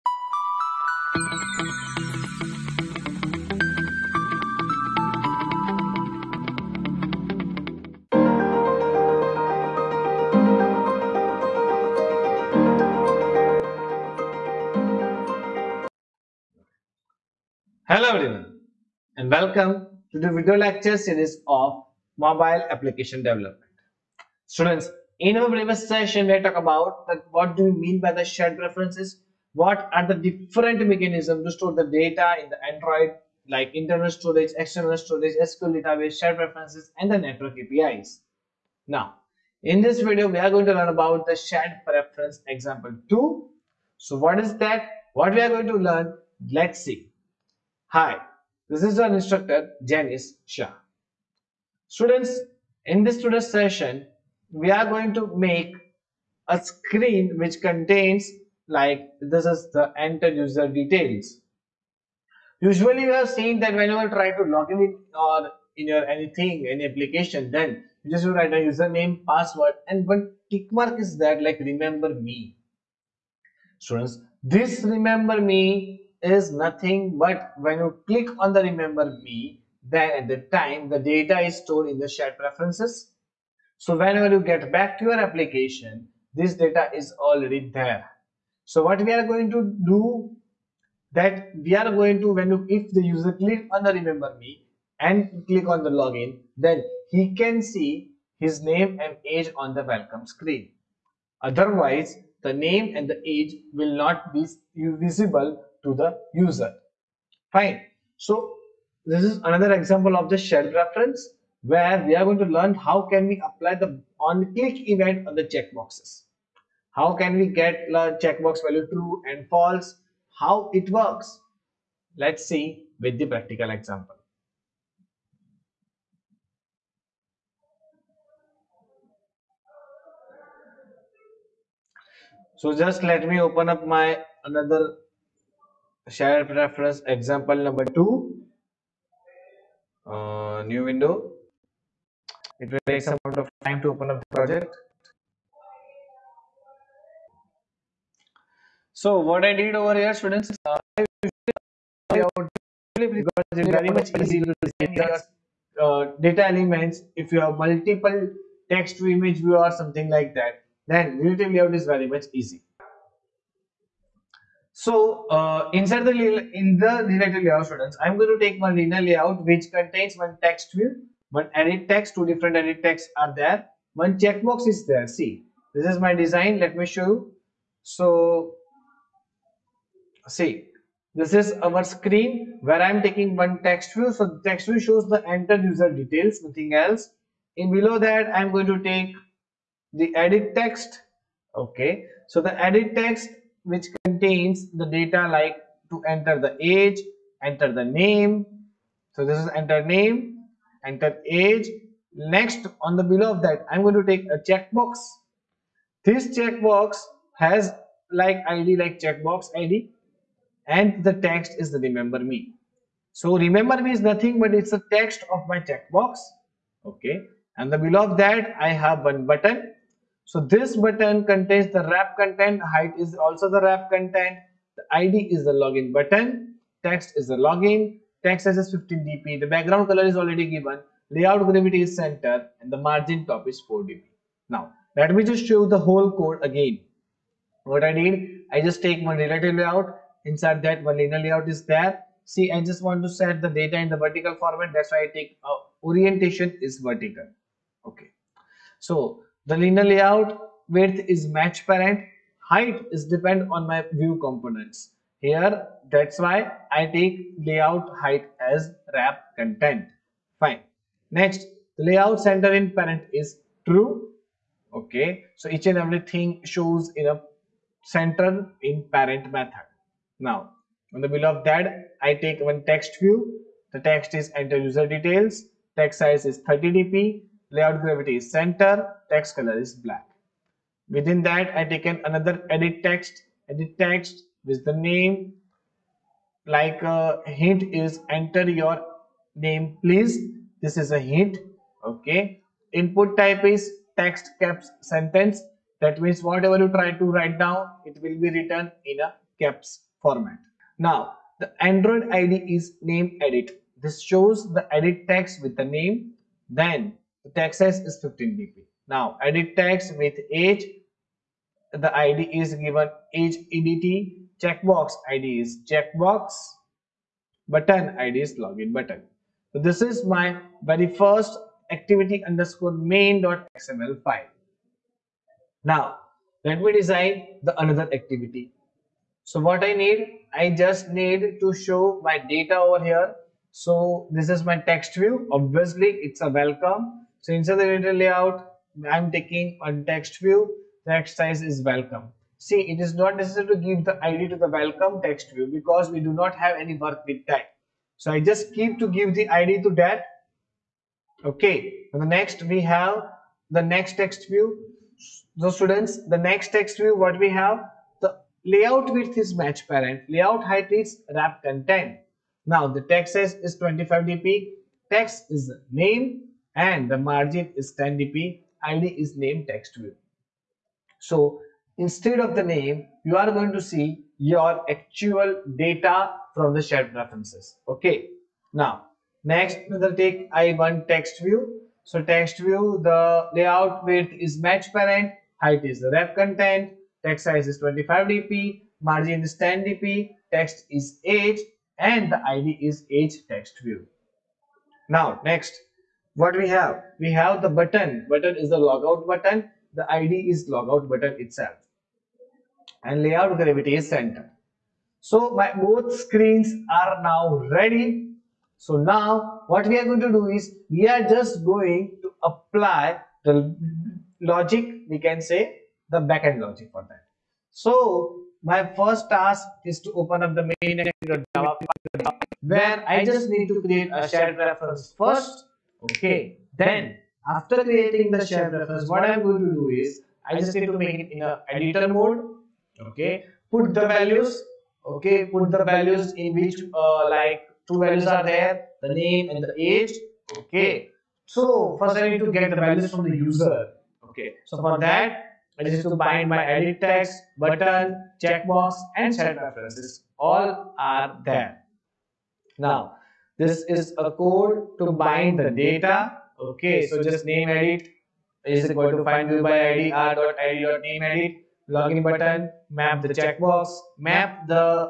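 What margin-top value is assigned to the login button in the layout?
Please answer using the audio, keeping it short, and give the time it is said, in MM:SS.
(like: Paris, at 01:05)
4 dp, at 03:52.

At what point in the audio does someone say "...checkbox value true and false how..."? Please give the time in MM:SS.
01:58.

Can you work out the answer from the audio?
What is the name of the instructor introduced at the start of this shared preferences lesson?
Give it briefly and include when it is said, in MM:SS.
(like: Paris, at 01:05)
Janice Shah, at 00:49.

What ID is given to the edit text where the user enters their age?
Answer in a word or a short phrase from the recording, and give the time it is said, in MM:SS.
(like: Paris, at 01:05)
age EDT, at 05:13.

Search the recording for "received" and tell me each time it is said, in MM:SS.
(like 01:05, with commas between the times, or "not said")
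not said.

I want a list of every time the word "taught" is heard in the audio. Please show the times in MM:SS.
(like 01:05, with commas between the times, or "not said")
not said.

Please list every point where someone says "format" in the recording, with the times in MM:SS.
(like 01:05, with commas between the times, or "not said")
04:04, 05:00.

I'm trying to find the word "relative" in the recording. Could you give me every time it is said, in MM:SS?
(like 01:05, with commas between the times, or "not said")
02:41, 02:47, 03:59.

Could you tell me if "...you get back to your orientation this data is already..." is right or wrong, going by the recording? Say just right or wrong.
wrong.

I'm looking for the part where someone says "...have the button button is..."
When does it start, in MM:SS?
06:37.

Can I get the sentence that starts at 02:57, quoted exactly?
So see, this is our screen where I'm taking one text view.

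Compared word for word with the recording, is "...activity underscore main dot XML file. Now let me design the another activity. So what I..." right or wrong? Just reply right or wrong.
right.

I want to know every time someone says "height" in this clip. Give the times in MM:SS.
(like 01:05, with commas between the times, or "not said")
03:42, 04:12, 04:17, 06:00, 06:25.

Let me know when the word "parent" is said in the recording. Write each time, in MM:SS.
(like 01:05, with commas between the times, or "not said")
04:11, 04:22, 04:28, 05:59, 06:24.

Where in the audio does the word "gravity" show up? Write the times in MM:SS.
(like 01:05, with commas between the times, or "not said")
03:51, 04:37, 06:43.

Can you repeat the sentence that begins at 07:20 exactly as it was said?
Okay, so first I need to get the values from the user.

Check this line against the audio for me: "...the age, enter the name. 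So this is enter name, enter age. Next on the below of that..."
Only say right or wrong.
right.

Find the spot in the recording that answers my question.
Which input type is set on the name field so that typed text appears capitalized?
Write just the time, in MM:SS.
04:53.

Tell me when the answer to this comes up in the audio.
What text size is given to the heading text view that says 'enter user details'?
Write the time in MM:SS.
04:35.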